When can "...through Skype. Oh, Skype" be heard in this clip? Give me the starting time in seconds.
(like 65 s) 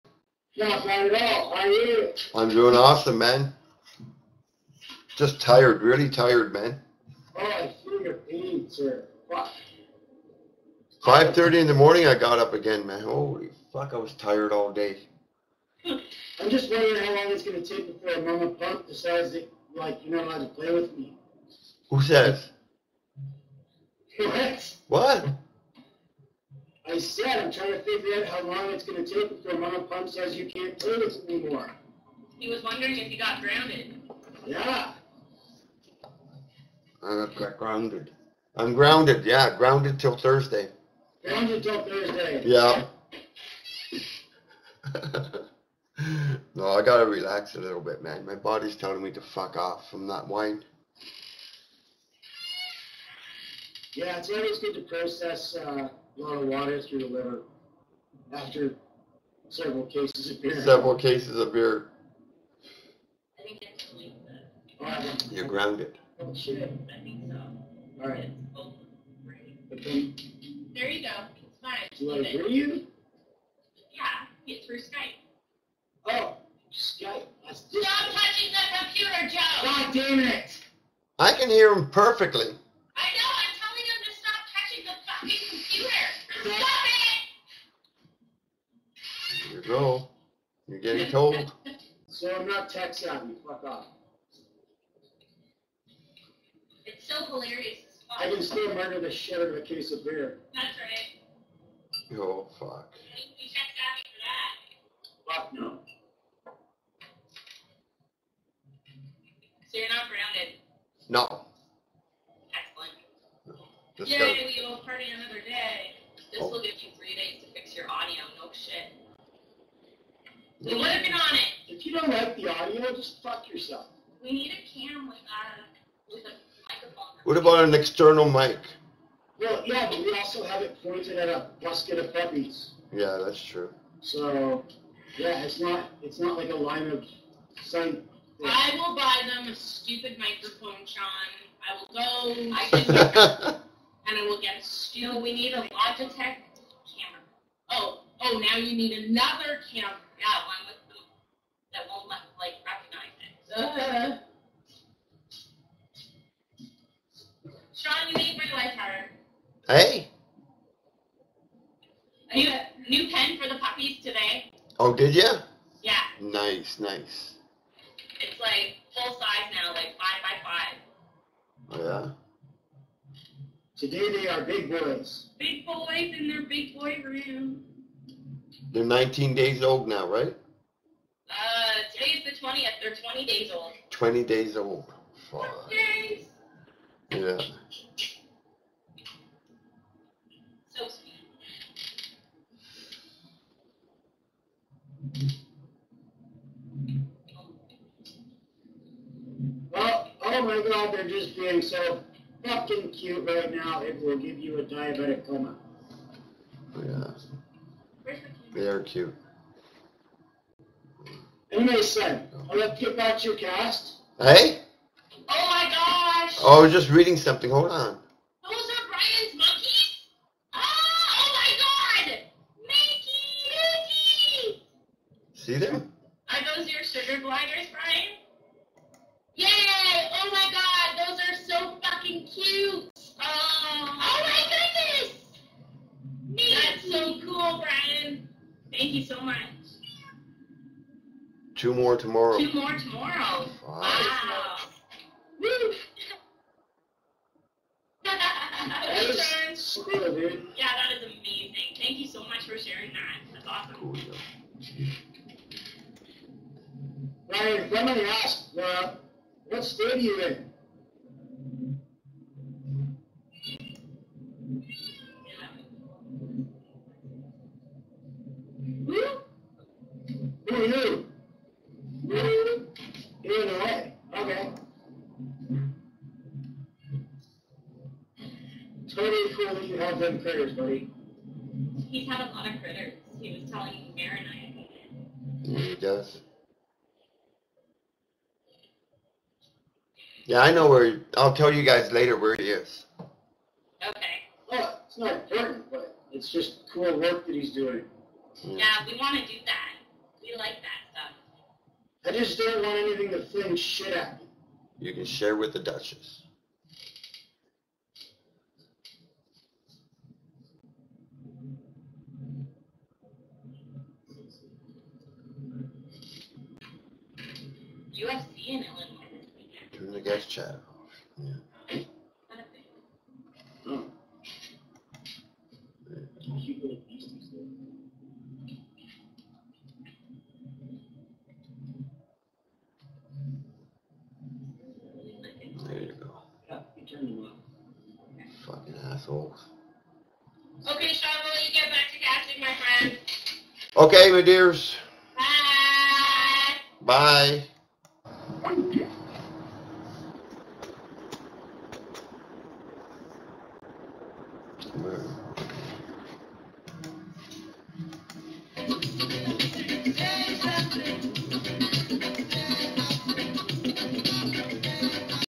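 74 s.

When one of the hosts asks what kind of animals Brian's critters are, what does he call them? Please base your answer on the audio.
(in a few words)
sugar gliders.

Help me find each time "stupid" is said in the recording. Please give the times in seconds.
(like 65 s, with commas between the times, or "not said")
139 s, 144 s.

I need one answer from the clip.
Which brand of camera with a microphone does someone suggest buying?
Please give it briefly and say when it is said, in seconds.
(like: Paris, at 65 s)
Logitech, at 145 s.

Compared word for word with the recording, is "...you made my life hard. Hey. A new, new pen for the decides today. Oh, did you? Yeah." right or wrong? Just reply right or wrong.
wrong.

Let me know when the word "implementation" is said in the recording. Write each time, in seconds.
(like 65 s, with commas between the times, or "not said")
not said.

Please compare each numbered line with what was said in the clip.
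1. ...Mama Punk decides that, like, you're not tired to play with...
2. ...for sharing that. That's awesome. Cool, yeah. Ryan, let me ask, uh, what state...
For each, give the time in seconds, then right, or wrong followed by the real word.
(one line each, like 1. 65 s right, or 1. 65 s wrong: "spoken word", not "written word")
1. 18 s wrong: "allowed", not "tired"
2. 252 s right.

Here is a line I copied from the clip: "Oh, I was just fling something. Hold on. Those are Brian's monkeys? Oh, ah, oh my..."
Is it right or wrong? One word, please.
wrong.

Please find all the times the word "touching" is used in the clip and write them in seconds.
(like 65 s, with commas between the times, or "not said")
78 s.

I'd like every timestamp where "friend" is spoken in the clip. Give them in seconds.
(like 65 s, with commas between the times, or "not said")
342 s.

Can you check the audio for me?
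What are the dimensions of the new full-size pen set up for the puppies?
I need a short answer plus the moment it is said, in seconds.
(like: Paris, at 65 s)
5 by 5, at 169 s.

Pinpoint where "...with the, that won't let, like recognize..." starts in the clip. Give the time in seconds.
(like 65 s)
150 s.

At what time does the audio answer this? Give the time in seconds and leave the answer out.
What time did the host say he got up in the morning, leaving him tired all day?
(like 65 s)
11 s.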